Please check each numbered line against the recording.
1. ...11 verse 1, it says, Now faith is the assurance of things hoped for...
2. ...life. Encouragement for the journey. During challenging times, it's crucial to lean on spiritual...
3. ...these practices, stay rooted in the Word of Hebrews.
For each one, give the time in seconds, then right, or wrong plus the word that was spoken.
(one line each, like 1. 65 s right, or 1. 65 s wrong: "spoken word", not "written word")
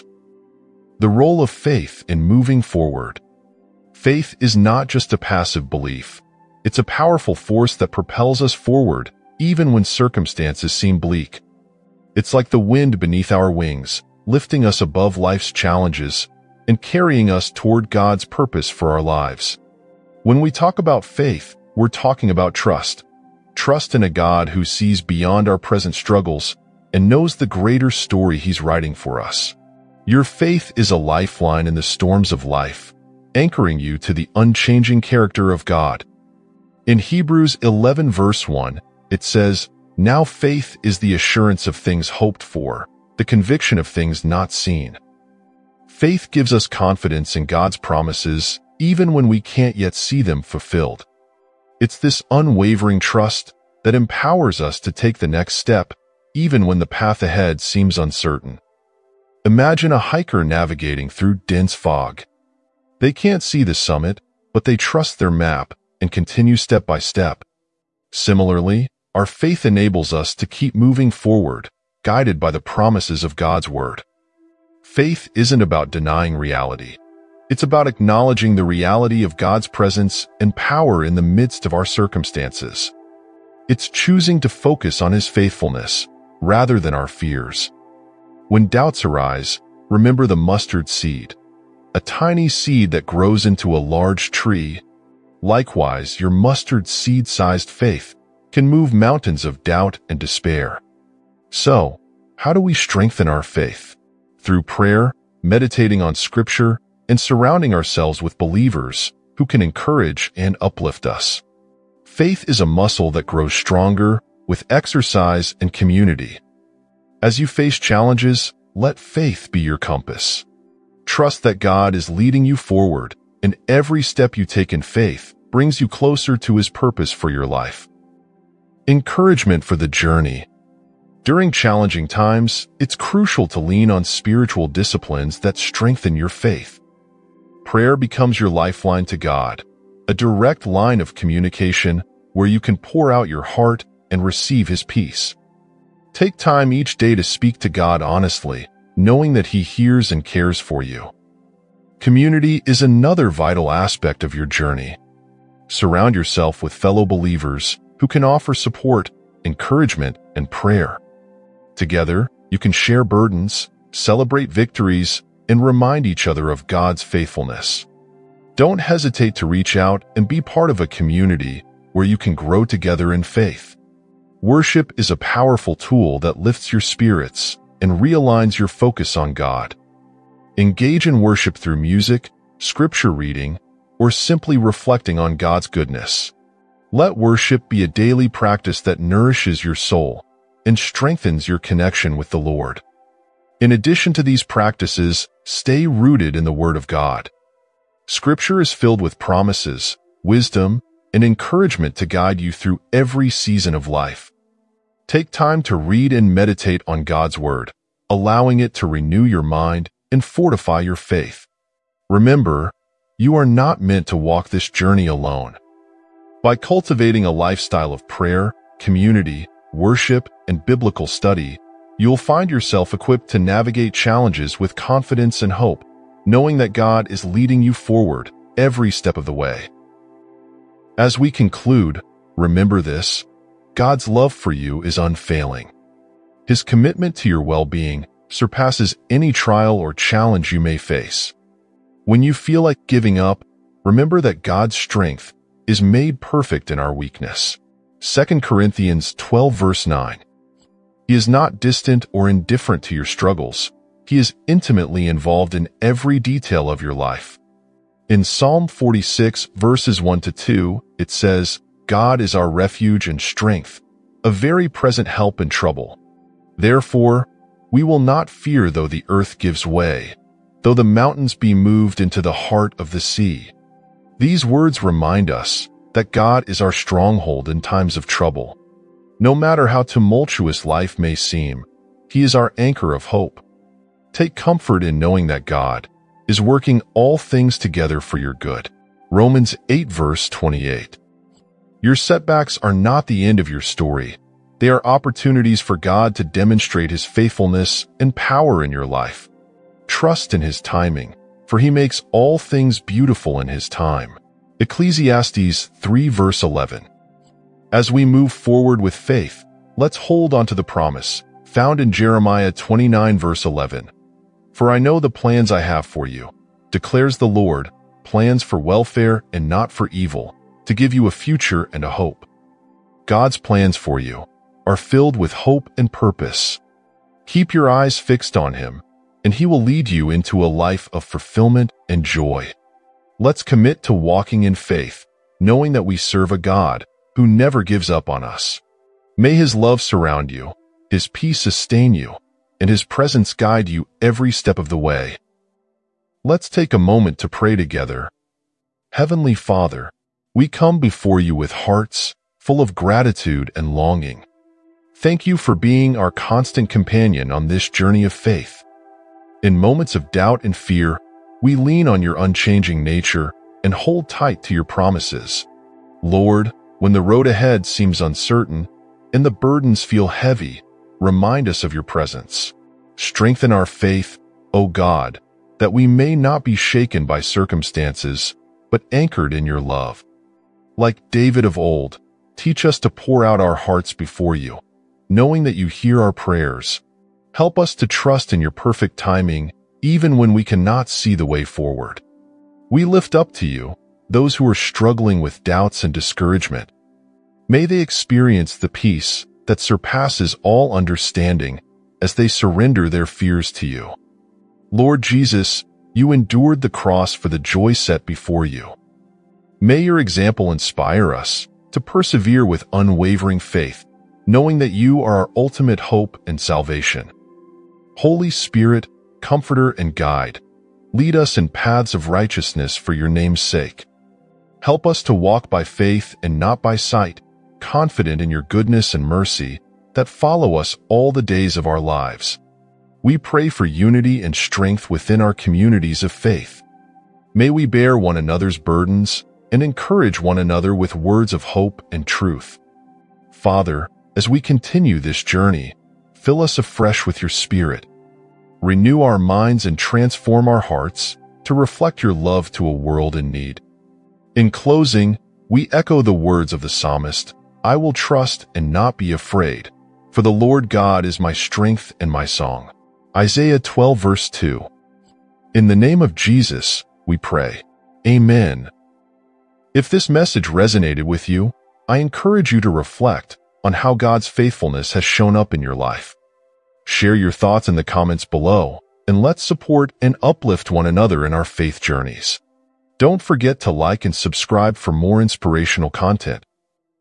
1. 37 s right
2. 127 s right
3. 194 s wrong: "God", not "Hebrews".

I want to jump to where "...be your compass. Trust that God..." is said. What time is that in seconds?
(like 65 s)
119 s.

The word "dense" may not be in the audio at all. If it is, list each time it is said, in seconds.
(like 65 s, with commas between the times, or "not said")
61 s.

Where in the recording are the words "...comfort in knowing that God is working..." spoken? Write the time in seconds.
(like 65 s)
284 s.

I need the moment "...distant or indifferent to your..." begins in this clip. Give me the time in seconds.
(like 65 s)
251 s.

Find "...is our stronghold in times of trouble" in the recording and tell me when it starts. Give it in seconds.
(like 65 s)
276 s.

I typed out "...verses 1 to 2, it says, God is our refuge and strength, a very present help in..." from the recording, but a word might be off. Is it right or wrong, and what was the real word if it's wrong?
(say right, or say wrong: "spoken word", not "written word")
right.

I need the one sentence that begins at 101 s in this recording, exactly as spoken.
So, how do we strengthen our faith?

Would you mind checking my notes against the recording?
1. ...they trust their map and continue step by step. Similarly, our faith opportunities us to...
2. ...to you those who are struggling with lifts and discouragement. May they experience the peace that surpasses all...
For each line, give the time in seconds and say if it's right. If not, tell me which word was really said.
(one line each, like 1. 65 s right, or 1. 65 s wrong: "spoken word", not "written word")
1. 64 s wrong: "enables", not "opportunities"
2. 393 s wrong: "doubts", not "lifts".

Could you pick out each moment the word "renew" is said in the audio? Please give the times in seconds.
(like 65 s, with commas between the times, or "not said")
208 s, 448 s.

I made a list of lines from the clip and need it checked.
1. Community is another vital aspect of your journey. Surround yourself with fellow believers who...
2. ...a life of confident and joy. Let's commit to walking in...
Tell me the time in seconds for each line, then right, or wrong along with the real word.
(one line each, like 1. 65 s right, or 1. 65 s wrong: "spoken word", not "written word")
1. 151 s right
2. 330 s wrong: "fulfillment", not "confident".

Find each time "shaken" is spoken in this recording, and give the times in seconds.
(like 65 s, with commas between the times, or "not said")
376 s.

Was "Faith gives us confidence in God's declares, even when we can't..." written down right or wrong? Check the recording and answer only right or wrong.
wrong.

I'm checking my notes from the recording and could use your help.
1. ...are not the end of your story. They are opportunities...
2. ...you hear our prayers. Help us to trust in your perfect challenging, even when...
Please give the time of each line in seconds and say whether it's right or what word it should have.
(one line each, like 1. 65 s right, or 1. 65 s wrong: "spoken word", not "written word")
1. 292 s right
2. 385 s wrong: "timing", not "challenging".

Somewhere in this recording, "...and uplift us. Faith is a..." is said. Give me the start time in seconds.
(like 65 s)
110 s.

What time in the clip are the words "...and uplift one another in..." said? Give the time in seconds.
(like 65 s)
480 s.